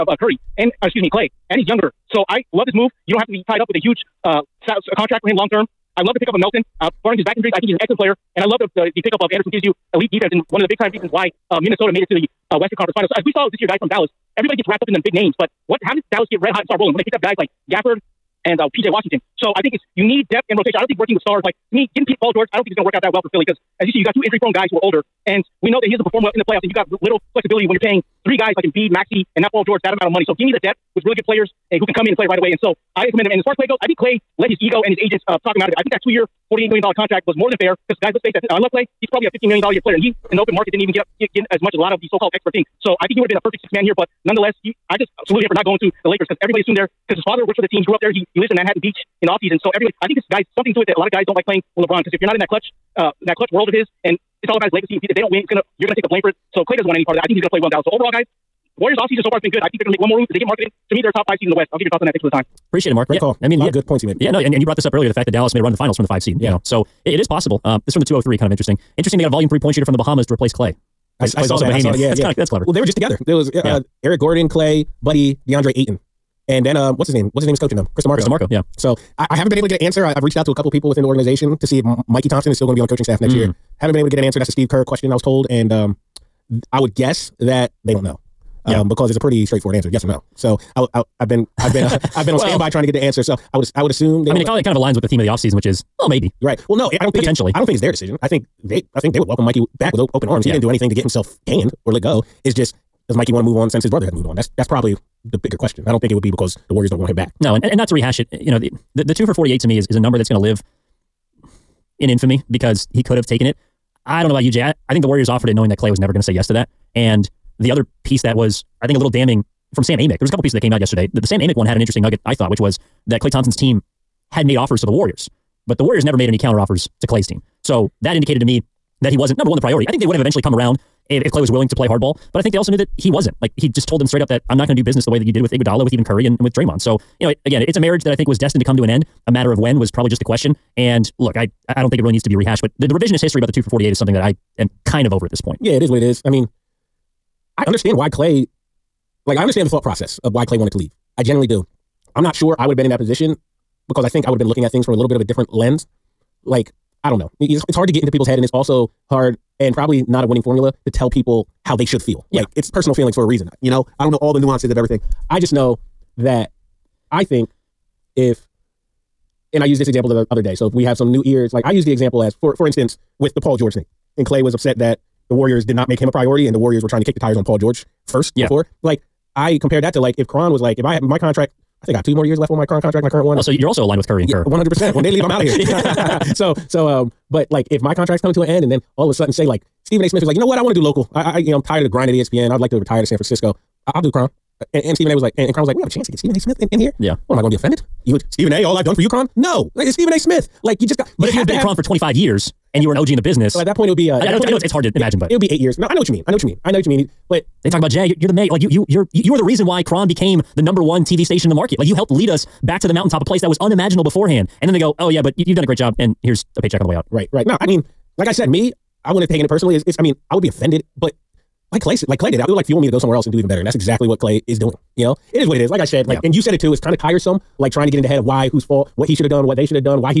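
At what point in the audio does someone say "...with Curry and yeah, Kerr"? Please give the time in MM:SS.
03:03.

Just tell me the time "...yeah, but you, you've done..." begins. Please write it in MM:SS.
03:35.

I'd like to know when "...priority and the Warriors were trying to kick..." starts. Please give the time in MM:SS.
02:56.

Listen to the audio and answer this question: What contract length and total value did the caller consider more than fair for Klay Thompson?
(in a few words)
2 years, $48 million.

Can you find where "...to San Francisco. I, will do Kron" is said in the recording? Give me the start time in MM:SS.
03:13.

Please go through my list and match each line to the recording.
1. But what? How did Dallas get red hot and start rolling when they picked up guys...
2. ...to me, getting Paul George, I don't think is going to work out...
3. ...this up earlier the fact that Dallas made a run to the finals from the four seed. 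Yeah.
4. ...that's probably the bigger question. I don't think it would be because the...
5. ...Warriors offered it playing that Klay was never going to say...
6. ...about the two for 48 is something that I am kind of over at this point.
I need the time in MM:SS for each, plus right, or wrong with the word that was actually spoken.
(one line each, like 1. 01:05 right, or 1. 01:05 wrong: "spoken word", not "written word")
1. 00:15 right
2. 00:21 right
3. 01:04 wrong: "five", not "four"
4. 01:44 right
5. 01:55 wrong: "knowing", not "playing"
6. 02:23 right.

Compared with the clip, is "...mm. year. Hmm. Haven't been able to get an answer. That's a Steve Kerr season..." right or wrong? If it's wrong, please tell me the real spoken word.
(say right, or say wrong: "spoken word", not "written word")
wrong: "question", not "season".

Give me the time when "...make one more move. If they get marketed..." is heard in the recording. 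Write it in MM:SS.
00:59.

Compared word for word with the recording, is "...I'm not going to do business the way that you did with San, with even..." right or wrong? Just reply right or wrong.
wrong.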